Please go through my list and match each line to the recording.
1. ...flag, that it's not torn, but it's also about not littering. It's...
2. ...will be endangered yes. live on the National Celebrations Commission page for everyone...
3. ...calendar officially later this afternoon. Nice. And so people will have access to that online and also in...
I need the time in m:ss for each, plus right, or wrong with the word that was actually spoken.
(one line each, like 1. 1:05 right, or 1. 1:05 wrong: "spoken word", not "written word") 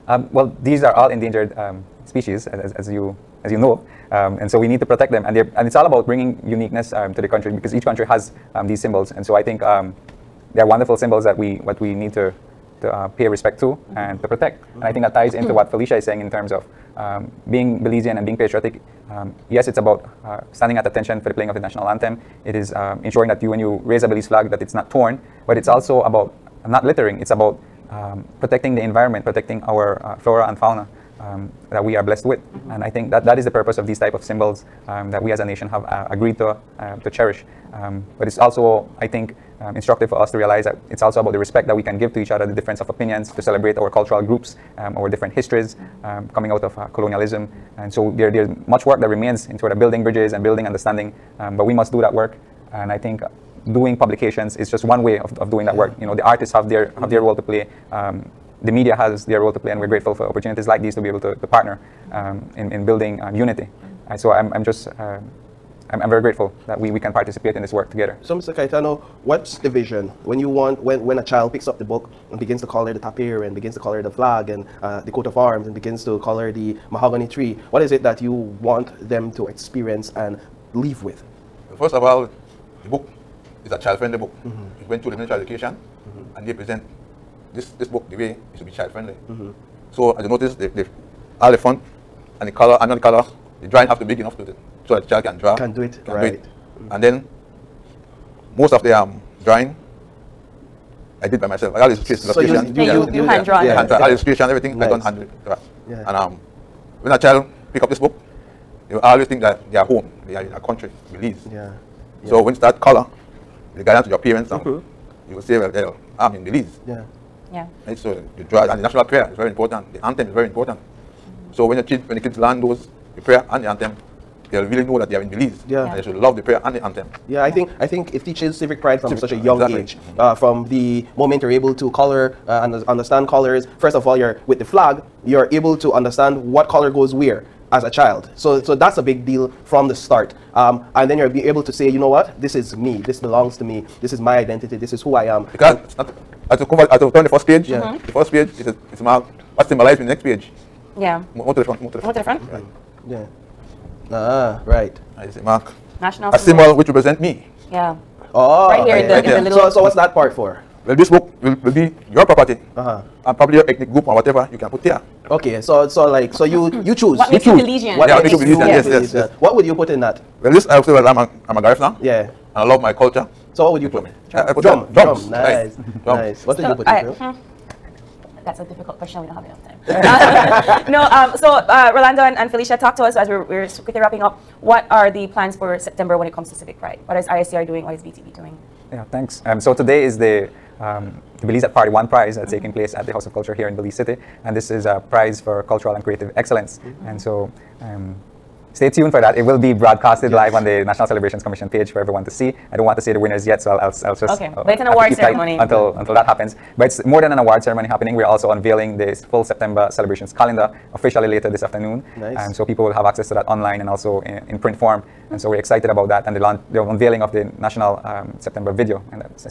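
1. 0:24 right
2. 3:19 wrong: "broadcasted", not "endangered"
3. 3:30 right.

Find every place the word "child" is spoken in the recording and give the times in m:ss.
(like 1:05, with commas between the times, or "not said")
1:11, 1:23, 1:28, 1:35, 1:47, 2:17.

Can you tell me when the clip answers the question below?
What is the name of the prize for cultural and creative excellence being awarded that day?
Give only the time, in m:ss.
3:11.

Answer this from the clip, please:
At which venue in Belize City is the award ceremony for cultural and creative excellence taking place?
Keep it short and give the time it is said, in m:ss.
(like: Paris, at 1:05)
House of Culture, at 3:13.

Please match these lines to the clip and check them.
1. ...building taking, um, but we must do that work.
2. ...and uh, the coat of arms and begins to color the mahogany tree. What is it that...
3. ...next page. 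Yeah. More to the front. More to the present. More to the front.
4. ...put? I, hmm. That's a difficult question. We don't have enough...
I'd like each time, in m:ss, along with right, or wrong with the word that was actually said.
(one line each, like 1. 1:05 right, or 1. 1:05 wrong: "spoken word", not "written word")
1. 0:50 wrong: "understanding", not "taking"
2. 1:14 right
3. 2:30 wrong: "front", not "present"
4. 2:56 right.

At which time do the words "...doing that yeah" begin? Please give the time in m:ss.
0:55.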